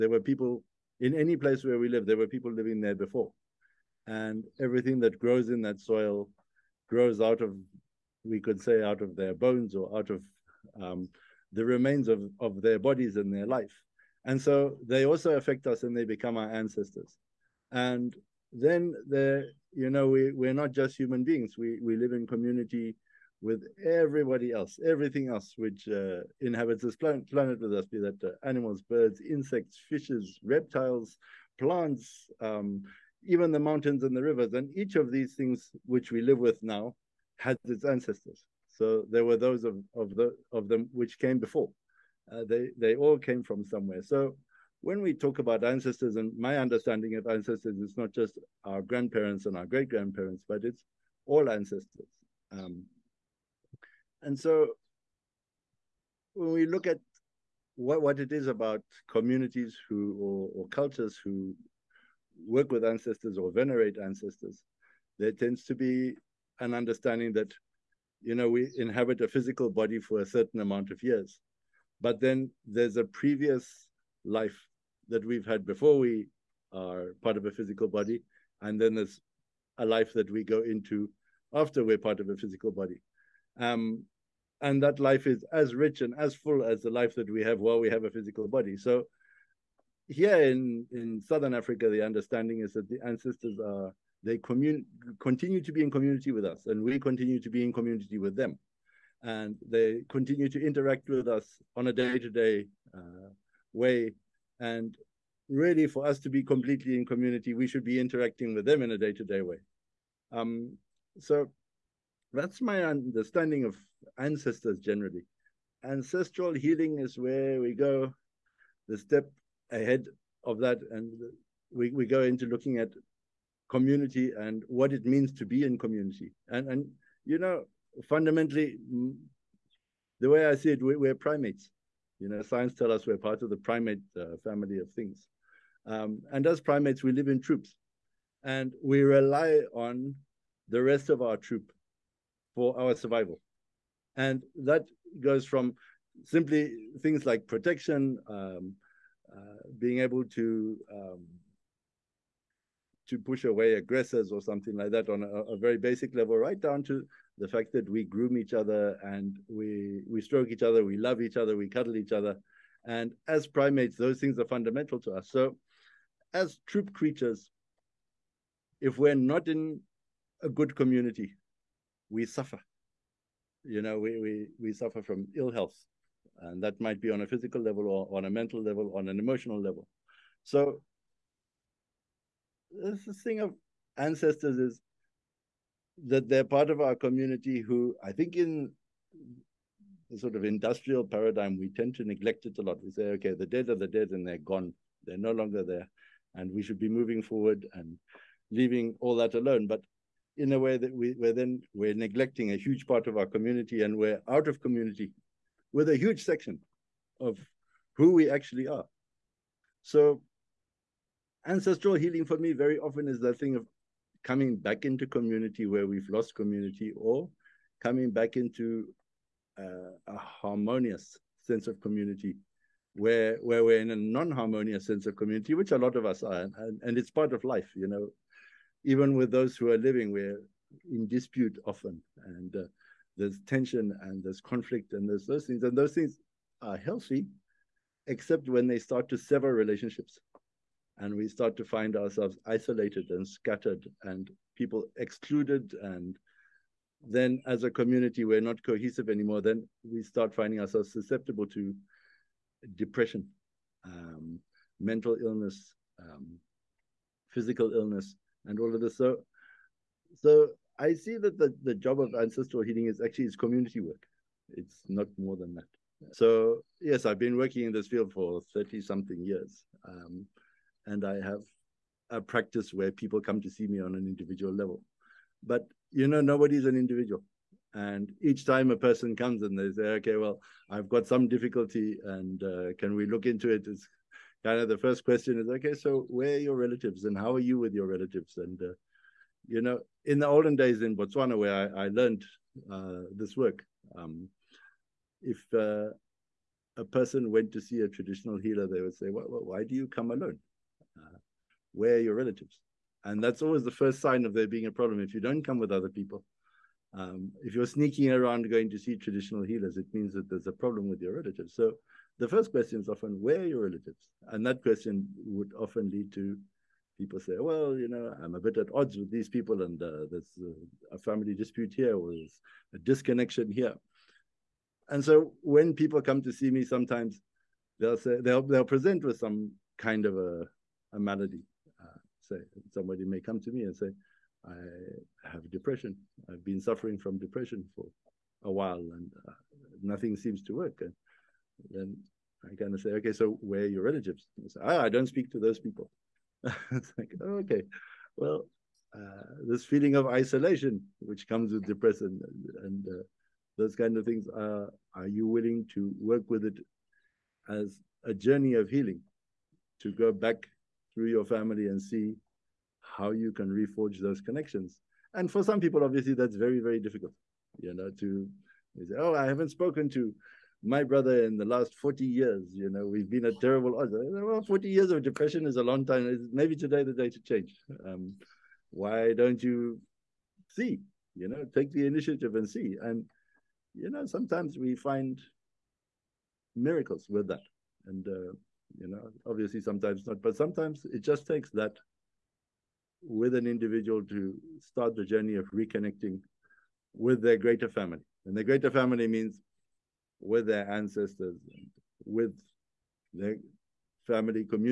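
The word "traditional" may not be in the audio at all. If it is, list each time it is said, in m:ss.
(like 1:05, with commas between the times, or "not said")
4:57, 5:08.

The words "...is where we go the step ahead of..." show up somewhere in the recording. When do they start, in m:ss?
1:56.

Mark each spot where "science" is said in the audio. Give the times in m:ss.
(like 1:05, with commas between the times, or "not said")
2:12.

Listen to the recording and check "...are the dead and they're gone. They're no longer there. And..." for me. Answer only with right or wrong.
right.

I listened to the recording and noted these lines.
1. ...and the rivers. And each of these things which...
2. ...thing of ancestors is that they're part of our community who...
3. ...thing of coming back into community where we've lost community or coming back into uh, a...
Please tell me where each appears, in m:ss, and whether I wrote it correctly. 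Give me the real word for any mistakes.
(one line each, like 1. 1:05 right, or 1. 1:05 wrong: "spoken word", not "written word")
1. 0:34 right
2. 3:03 right
3. 3:33 right.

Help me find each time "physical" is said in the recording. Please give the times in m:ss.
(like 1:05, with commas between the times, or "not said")
1:09, 1:17, 1:22, 1:28, 2:57, 4:17.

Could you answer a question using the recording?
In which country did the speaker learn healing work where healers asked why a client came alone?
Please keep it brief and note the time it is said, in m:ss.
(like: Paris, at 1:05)
Botswana, at 4:50.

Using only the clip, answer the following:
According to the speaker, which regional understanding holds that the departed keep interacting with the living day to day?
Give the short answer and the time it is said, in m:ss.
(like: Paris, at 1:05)
southern Africa, at 1:31.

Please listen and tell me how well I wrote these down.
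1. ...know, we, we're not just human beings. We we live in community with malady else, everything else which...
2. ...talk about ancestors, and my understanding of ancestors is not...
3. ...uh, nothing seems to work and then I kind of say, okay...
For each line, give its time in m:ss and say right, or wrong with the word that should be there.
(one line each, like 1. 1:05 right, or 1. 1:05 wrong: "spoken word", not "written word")
1. 0:19 wrong: "everybody", not "malady"
2. 0:45 right
3. 5:39 right.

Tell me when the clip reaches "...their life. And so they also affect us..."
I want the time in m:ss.
0:13.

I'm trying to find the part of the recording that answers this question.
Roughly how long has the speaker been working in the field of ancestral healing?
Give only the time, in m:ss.
4:28.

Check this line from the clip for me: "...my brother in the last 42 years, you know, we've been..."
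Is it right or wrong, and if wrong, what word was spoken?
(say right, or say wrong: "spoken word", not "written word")
wrong: "40", not "42".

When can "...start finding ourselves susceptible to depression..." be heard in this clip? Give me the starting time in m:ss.
4:10.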